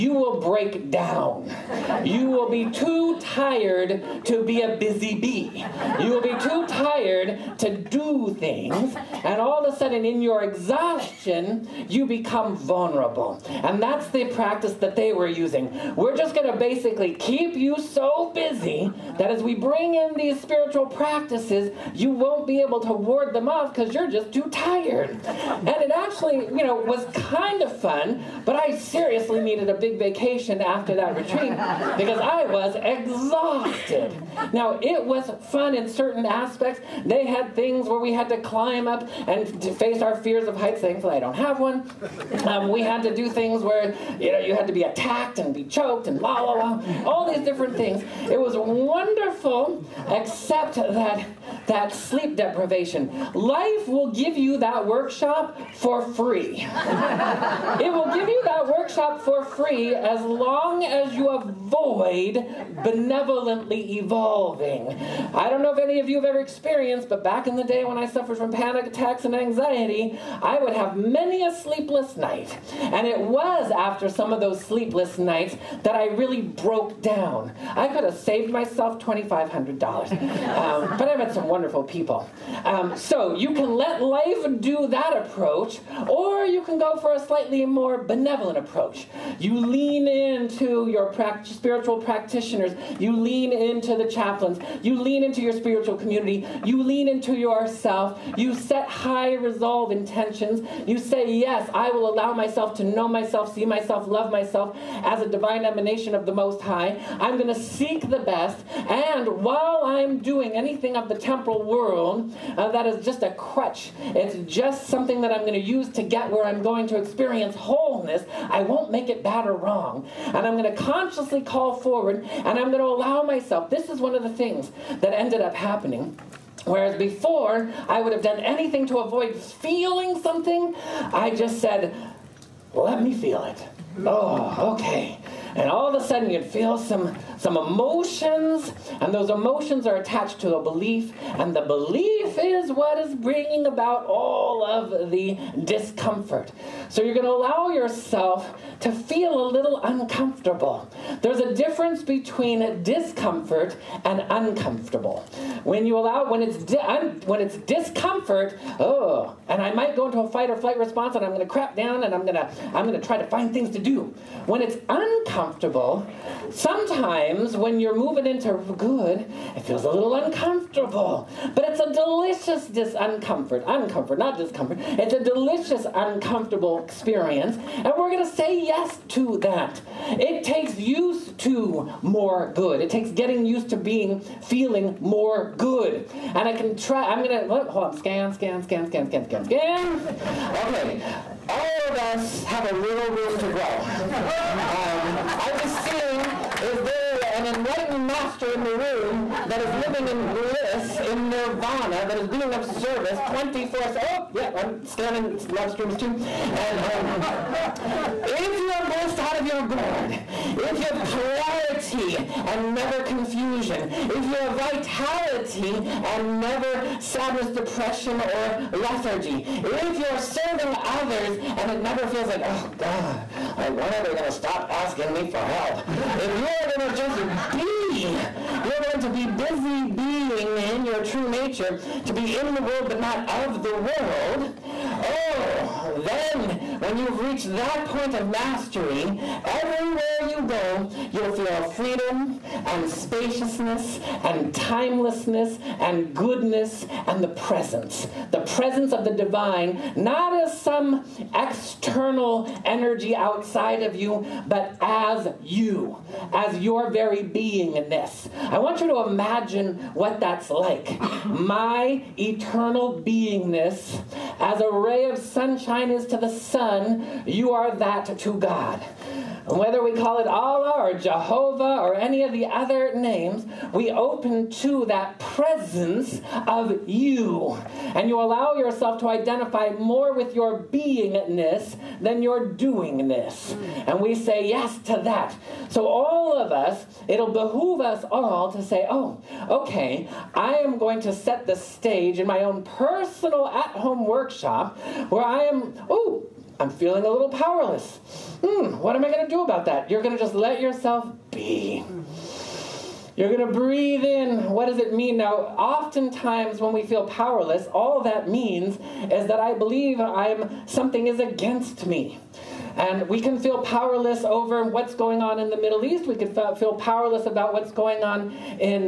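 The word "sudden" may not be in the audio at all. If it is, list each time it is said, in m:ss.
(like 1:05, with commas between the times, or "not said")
0:09, 2:16.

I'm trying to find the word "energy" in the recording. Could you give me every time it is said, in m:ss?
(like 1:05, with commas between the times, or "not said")
4:12.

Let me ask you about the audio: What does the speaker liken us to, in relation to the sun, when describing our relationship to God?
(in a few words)
a ray of sunshine.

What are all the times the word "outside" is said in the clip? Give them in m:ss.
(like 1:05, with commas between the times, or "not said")
4:13.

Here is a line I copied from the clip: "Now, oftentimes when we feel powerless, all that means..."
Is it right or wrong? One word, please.
right.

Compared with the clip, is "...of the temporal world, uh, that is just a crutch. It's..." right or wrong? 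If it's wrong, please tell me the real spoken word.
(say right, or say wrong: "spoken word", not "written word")
right.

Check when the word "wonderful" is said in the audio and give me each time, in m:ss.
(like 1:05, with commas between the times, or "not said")
0:48, 1:21.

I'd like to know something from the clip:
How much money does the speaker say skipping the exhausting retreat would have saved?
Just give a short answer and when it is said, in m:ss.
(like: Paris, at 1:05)
$2,500, at 1:19.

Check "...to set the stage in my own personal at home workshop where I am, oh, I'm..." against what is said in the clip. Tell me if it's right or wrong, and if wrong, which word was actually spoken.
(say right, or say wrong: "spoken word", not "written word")
right.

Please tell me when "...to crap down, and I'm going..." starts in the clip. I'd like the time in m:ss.
2:41.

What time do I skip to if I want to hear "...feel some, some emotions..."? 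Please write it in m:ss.
2:16.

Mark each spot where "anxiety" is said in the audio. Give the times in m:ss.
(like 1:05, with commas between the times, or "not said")
1:09.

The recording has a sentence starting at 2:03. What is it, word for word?
This is one of the things that ended up happening Whereas before, I would have done anything to avoid feeling something.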